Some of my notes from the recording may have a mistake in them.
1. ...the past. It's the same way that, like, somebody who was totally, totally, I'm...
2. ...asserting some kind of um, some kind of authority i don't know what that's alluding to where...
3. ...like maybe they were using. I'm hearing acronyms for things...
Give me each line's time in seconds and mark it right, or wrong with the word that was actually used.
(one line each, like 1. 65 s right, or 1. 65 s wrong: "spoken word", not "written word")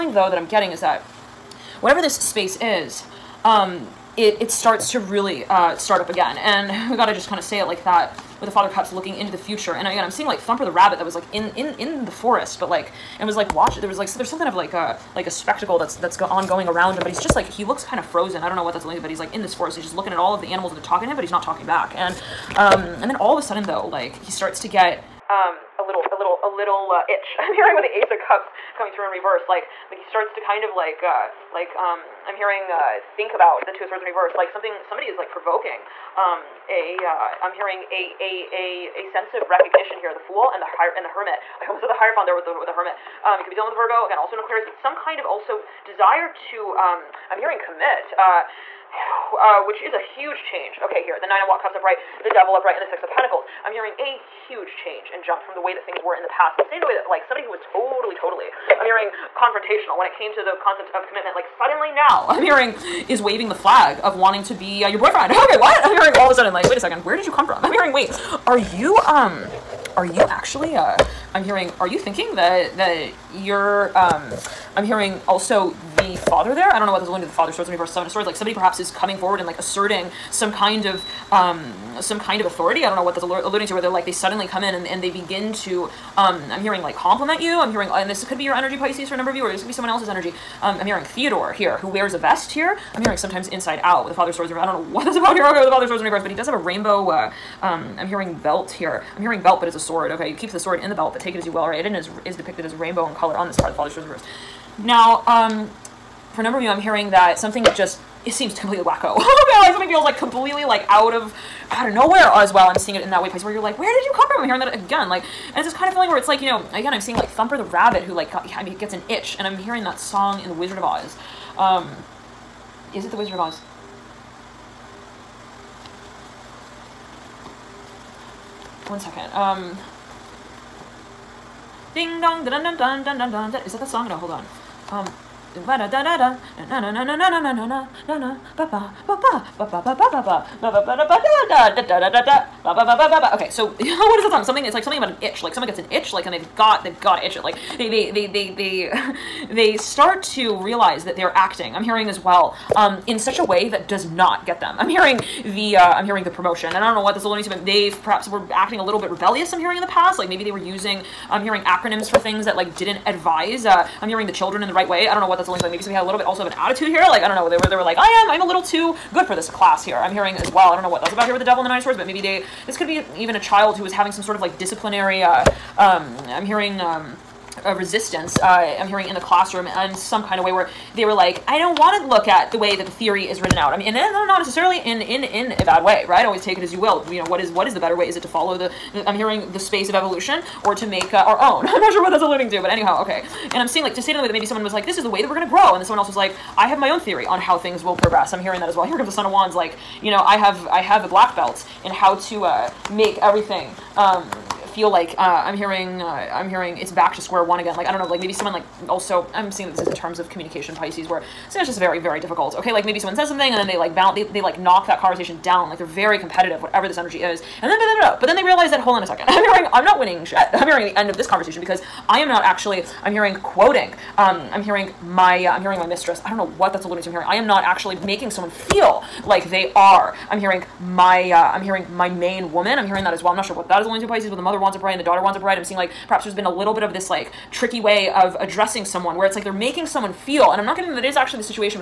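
1. 56 s right
2. 79 s right
3. 160 s right.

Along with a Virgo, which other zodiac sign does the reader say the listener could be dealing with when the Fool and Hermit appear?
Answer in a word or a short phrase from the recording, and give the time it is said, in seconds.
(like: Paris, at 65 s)
Aquarius, at 44 s.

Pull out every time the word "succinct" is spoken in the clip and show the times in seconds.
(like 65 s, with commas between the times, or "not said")
not said.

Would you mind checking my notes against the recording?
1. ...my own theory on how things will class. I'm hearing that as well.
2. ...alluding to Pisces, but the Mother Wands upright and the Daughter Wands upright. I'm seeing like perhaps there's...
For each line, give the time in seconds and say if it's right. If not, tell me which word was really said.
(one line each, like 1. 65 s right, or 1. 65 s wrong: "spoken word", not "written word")
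1. 196 s wrong: "progress", not "class"
2. 233 s right.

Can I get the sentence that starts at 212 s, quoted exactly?
Okay, like maybe someone says something and then they like bounce they, they like knock that conversation down.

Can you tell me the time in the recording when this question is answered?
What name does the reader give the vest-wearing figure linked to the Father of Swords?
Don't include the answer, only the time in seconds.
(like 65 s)
91 s.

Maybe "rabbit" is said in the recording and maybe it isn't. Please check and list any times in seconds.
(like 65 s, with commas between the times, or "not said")
10 s, 117 s.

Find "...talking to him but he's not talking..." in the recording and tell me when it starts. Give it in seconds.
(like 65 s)
20 s.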